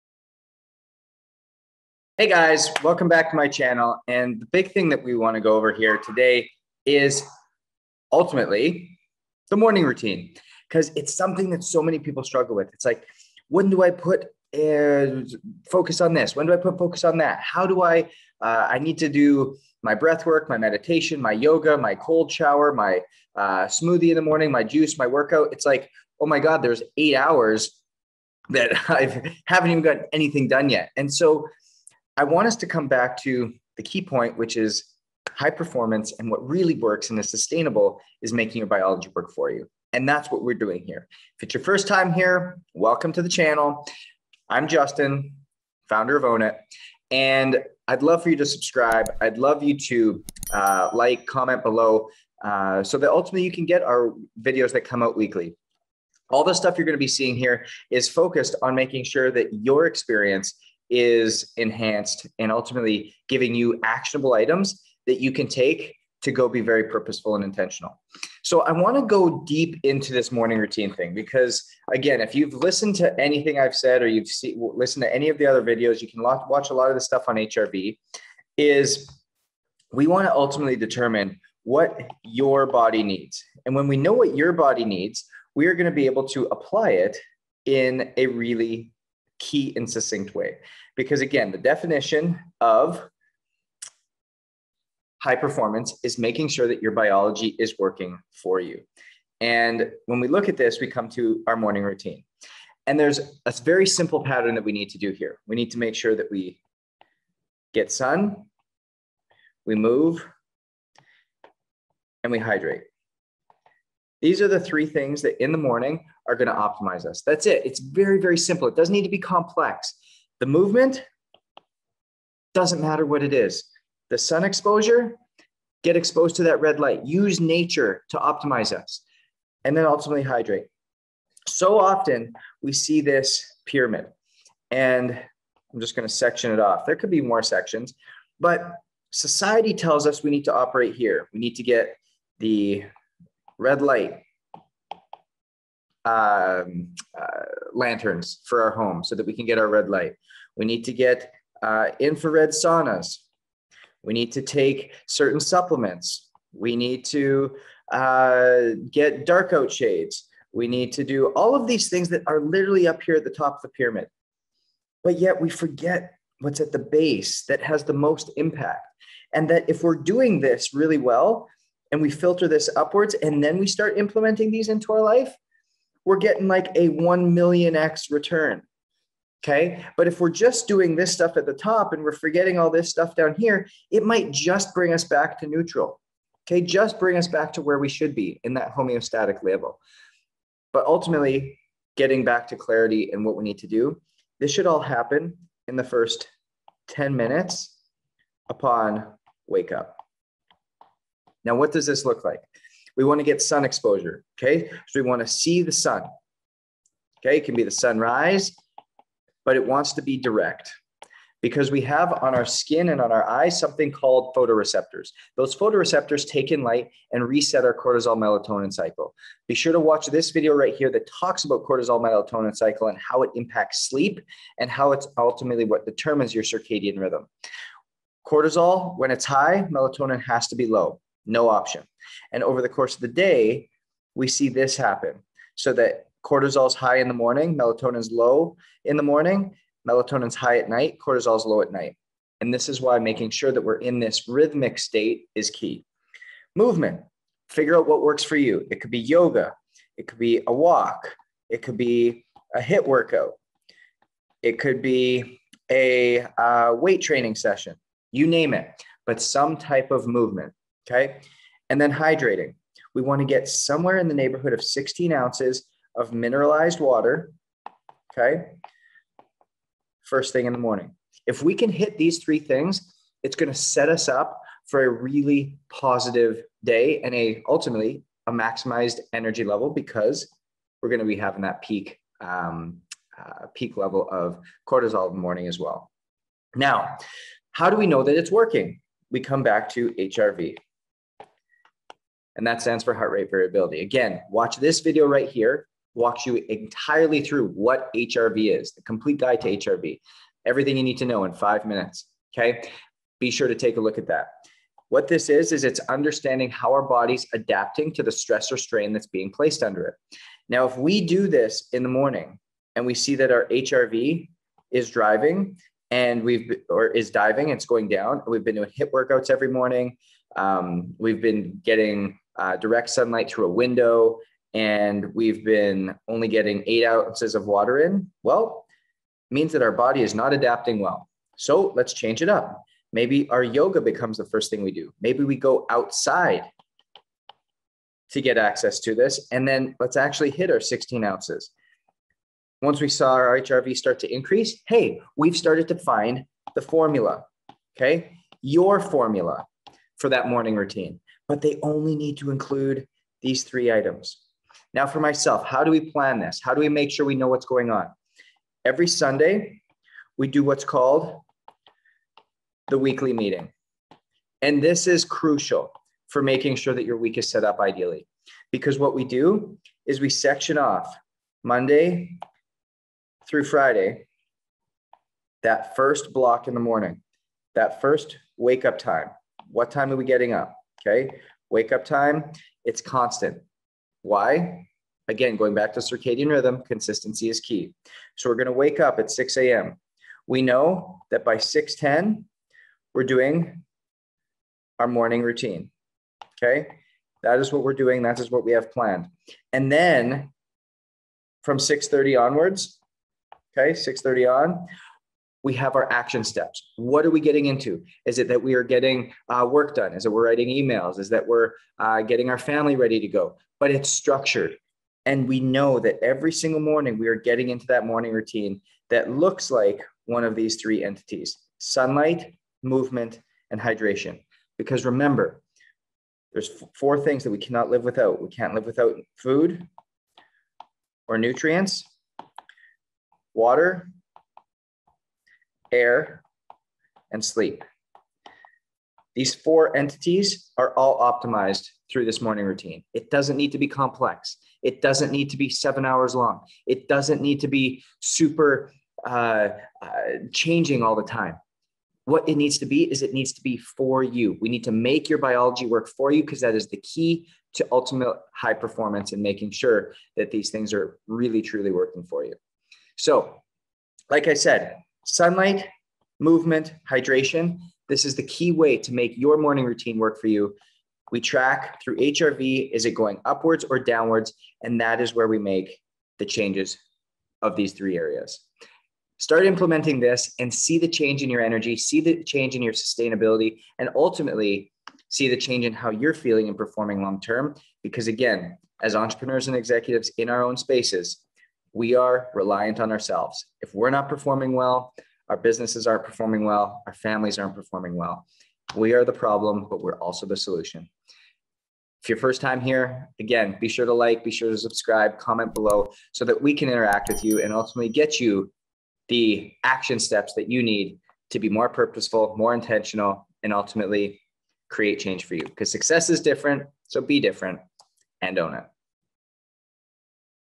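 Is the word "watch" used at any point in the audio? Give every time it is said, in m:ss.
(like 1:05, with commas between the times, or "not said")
1:16, 3:39, 4:54.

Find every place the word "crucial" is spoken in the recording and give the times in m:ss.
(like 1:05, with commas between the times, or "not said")
6:05.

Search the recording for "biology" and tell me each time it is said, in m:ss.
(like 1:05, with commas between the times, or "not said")
0:38, 1:36, 7:35.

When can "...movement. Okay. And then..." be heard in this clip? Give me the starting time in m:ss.
4:20.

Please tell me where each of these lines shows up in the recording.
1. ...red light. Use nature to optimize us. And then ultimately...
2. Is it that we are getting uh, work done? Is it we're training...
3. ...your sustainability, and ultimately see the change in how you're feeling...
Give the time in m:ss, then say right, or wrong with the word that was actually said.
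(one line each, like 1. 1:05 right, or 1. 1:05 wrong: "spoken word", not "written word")
1. 2:06 right
2. 6:48 wrong: "writing", not "training"
3. 8:02 right.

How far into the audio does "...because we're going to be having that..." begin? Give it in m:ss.
4:39.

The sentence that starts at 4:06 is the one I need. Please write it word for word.
Movement, figure out what works for you.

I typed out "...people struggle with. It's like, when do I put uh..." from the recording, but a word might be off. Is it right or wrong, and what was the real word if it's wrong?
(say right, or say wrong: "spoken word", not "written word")
right.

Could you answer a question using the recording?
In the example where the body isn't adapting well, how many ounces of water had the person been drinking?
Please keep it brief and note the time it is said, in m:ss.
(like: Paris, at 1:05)
8, at 5:26.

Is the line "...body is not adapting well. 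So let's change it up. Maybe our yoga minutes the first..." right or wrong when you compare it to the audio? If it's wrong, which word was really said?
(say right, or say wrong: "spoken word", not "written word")
wrong: "becomes", not "minutes".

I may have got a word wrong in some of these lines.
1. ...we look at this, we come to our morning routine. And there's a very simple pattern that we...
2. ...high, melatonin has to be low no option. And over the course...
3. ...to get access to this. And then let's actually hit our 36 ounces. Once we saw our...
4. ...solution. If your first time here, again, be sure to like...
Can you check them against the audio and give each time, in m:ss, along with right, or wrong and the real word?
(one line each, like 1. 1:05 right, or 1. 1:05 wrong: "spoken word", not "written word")
1. 1:40 right
2. 3:49 right
3. 5:38 wrong: "16", not "36"
4. 8:20 right.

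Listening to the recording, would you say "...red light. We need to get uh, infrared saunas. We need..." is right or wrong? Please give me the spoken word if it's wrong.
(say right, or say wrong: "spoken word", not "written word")
right.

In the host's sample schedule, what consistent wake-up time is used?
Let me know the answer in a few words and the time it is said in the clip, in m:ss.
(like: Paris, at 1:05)
6 a.m., at 6:29.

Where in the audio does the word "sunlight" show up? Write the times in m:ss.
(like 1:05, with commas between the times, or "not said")
5:22, 7:01, 7:45.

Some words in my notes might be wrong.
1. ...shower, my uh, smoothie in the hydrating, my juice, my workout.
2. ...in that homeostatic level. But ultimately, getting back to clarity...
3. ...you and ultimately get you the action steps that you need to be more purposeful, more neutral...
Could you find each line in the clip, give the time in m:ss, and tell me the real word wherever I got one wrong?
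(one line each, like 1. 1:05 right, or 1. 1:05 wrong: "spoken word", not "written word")
1. 0:22 wrong: "morning", not "hydrating"
2. 3:08 right
3. 8:27 wrong: "intentional", not "neutral".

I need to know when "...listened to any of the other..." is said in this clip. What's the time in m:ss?
1:14.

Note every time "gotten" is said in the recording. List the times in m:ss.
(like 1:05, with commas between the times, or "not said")
0:29.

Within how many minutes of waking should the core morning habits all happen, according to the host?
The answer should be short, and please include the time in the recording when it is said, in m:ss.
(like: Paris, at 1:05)
10, at 3:16.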